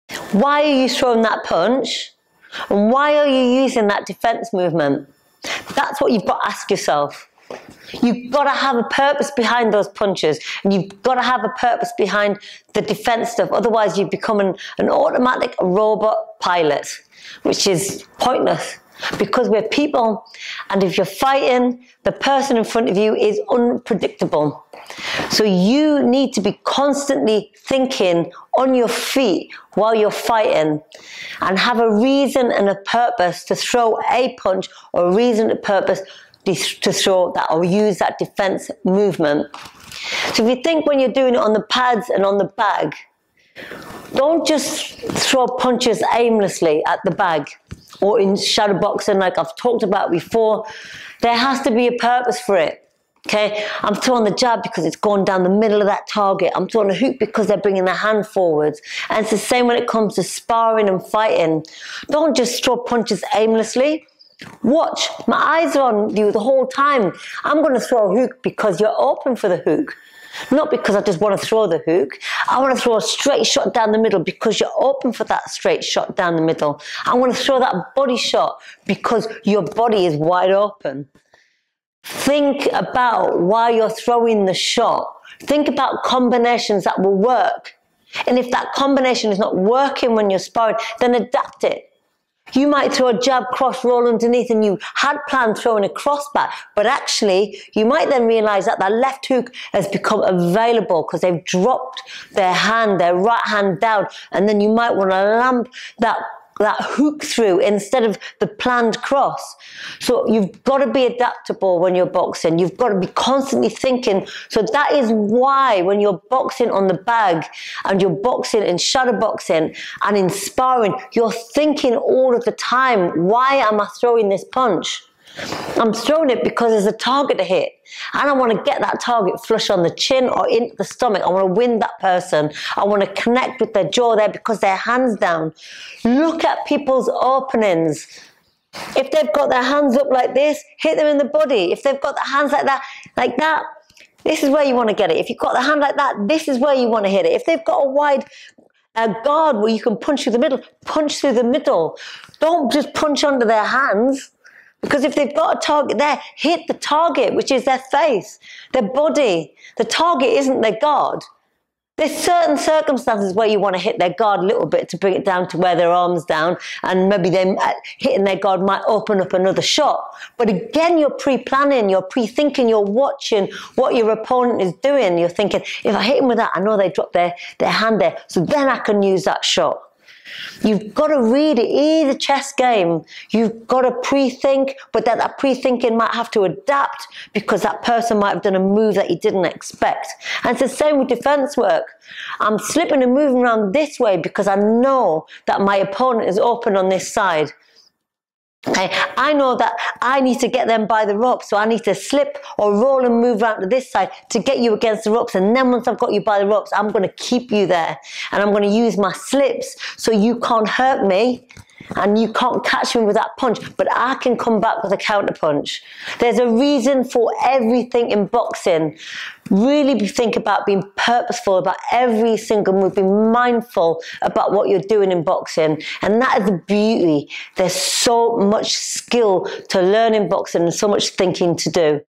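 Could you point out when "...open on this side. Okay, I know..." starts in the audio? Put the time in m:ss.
3:16.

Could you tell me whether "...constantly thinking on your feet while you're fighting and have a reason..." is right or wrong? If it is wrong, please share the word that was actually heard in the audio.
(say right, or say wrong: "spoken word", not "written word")
right.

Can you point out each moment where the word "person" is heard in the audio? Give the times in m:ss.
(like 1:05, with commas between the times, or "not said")
0:22, 2:11, 3:07.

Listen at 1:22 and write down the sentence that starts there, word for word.
Think about why you're throwing the shot.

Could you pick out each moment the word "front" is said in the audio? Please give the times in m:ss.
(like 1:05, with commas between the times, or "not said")
0:22.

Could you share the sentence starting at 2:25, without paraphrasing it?
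If you've got the hand like that, this is where you want to hit it.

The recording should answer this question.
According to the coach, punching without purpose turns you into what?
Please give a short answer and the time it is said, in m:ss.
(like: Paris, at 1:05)
automatic robot pilot, at 0:14.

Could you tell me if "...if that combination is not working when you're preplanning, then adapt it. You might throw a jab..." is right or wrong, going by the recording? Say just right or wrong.
wrong.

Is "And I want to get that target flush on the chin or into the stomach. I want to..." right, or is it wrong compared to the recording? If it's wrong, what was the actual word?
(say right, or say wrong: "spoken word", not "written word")
right.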